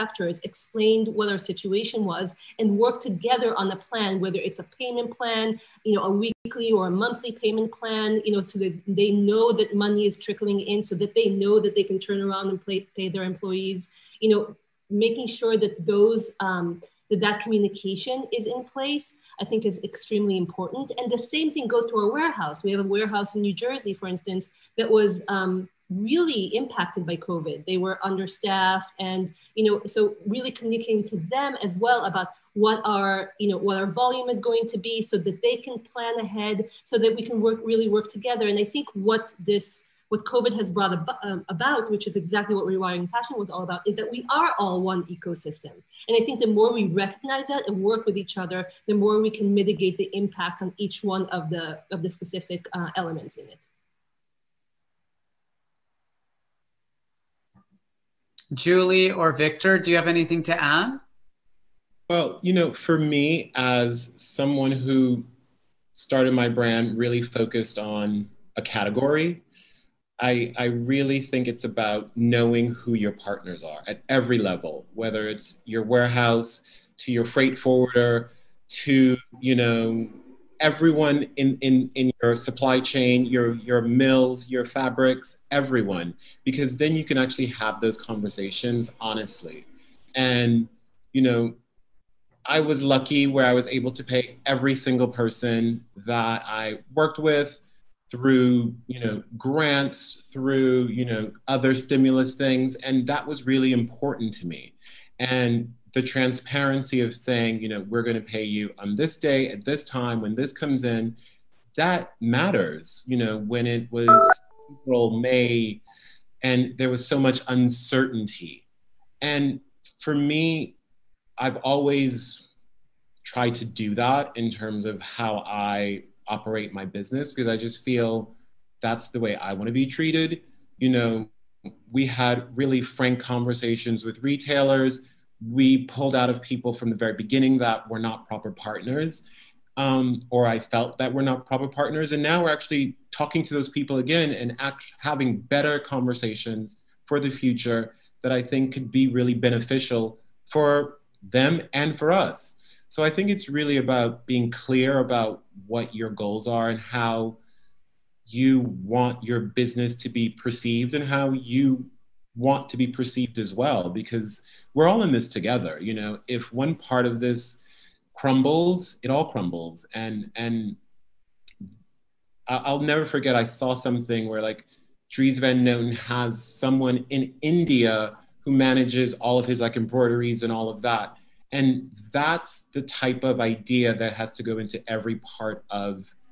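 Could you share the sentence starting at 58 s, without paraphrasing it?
Julie or Victor, do you have anything to add?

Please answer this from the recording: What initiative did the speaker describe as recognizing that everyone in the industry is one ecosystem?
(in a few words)
Rewiring Fashion.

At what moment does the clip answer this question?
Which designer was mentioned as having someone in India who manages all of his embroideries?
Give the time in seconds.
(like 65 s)
175 s.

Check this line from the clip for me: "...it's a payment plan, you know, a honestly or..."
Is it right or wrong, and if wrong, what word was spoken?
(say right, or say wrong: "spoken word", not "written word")
wrong: "weekly", not "honestly".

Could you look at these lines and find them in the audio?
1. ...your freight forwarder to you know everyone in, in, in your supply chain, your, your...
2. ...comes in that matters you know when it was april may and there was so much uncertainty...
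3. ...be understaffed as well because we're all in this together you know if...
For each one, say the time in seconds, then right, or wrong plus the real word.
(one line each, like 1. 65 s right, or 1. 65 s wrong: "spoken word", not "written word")
1. 77 s right
2. 110 s right
3. 162 s wrong: "perceived", not "understaffed".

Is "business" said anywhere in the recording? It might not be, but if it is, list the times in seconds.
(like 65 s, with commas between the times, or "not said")
126 s, 159 s.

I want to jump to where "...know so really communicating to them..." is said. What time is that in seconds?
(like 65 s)
29 s.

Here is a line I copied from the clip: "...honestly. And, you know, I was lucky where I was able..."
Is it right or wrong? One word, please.
right.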